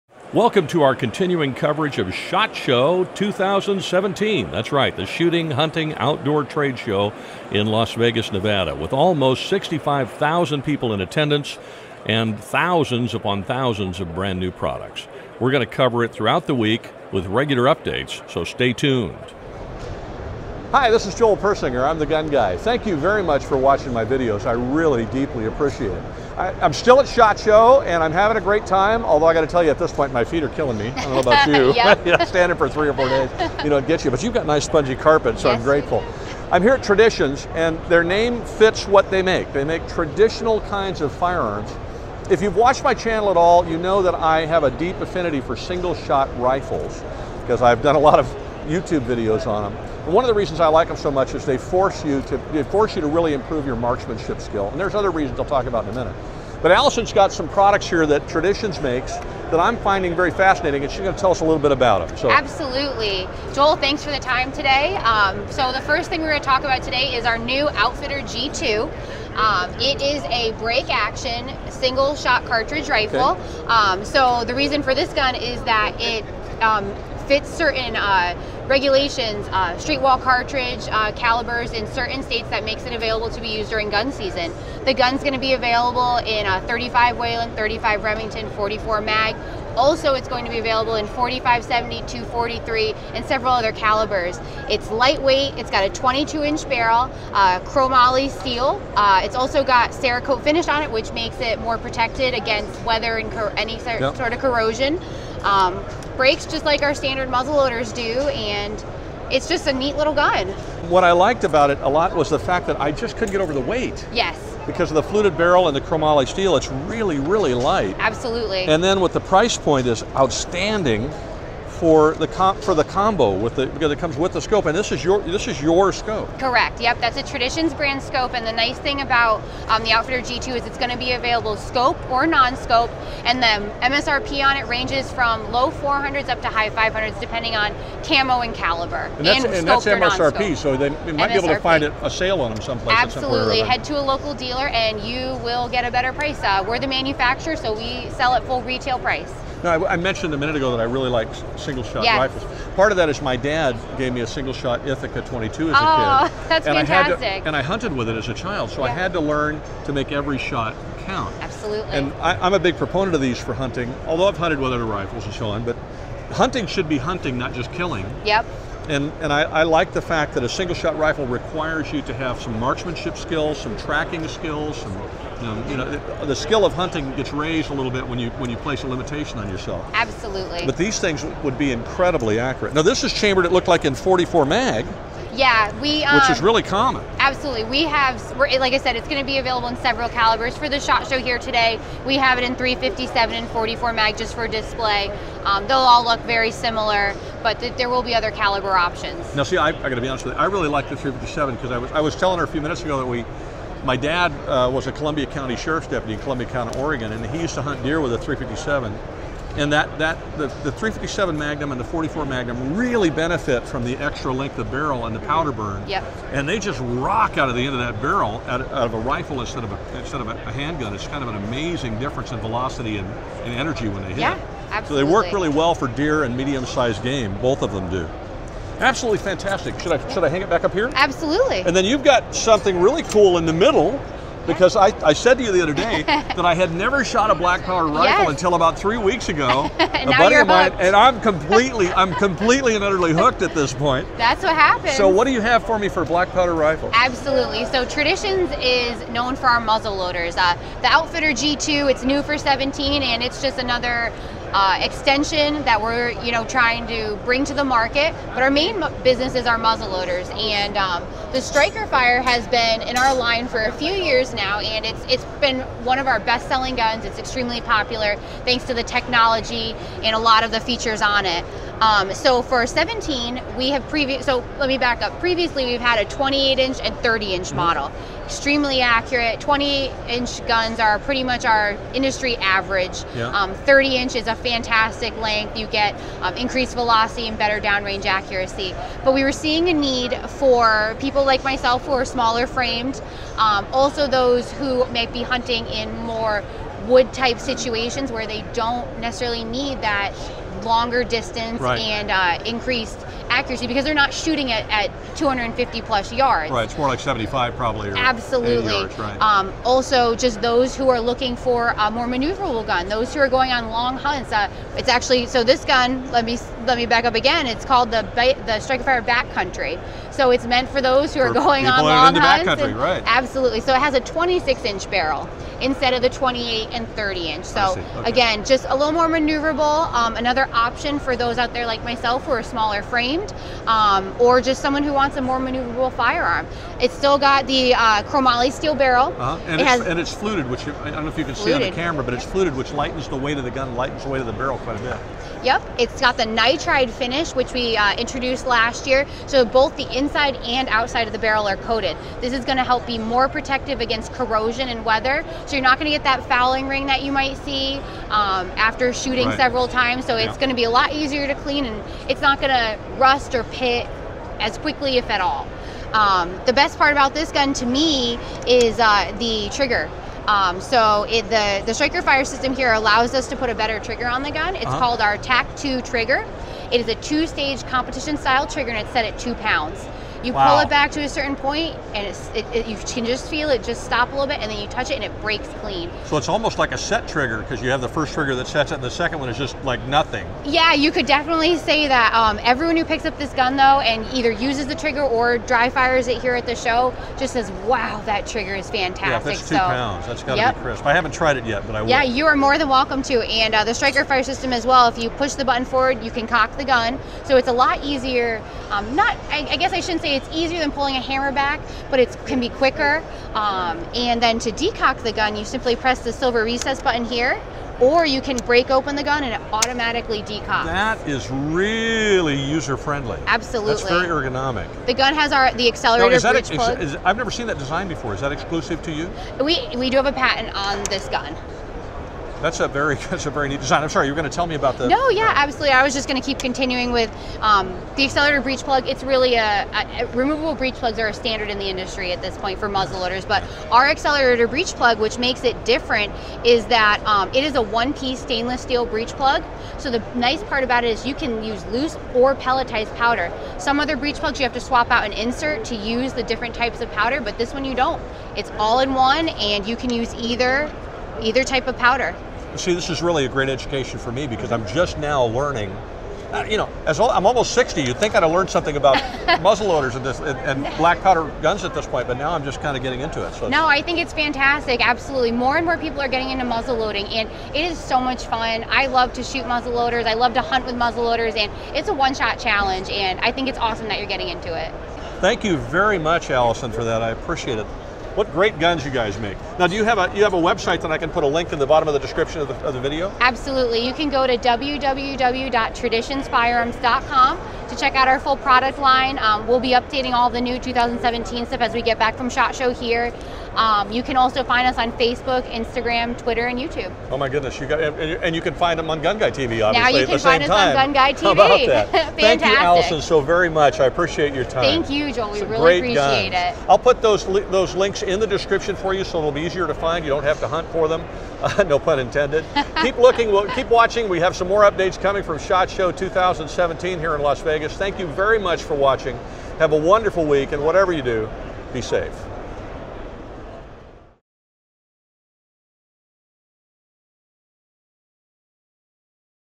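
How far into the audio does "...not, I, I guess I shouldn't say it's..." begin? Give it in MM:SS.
06:48.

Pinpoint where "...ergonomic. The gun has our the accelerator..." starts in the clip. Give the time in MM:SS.
07:04.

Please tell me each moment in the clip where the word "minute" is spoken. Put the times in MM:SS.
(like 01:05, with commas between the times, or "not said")
00:55, 02:30, 03:22.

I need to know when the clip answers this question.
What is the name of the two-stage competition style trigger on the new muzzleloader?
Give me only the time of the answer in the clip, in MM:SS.
06:15.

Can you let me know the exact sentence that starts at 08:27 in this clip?
Oh my goodness, you got, and you can find them on Gun Guy TV, obviously.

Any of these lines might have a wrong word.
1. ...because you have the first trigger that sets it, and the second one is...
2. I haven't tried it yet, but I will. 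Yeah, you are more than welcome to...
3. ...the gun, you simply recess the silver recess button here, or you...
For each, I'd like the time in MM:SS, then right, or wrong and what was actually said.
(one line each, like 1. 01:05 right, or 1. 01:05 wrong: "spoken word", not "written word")
1. 06:27 right
2. 06:40 right
3. 06:55 wrong: "press", not "recess".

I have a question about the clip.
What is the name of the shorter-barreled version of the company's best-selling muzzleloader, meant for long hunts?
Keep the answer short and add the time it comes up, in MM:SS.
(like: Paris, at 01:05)
Striker Fire Backcountry, at 05:18.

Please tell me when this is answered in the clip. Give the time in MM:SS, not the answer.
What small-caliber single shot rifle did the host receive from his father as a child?
02:34.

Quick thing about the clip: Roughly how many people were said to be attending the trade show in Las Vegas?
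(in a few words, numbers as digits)
65,000.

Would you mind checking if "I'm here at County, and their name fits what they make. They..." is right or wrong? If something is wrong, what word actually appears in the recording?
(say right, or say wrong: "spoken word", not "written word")
wrong: "Traditions", not "County".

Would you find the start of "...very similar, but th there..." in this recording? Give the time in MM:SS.
03:16.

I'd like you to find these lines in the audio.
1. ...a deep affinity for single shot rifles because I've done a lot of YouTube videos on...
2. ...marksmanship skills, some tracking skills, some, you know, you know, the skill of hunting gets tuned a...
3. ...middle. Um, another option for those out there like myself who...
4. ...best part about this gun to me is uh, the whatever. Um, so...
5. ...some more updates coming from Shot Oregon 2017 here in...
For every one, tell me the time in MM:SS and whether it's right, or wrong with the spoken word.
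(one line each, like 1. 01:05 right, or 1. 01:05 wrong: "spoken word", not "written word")
1. 00:44 right
2. 02:52 wrong: "raised", not "tuned"
3. 05:29 wrong: "maneuverable", not "middle"
4. 06:06 wrong: "trigger", not "whatever"
5. 08:44 wrong: "Show", not "Oregon".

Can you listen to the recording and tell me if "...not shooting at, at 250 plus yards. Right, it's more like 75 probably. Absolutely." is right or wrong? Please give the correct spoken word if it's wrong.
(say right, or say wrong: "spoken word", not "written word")
right.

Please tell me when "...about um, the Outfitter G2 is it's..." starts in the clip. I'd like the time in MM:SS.
02:09.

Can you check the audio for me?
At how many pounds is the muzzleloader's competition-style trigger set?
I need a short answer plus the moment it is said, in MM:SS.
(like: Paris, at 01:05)
2 pounds, at 06:19.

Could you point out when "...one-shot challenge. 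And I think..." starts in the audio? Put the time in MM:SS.
08:01.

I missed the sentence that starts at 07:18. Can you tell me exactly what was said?
It's really a, a, a, removable breech plugs are a standard in the industry at this point for muzzle loaders.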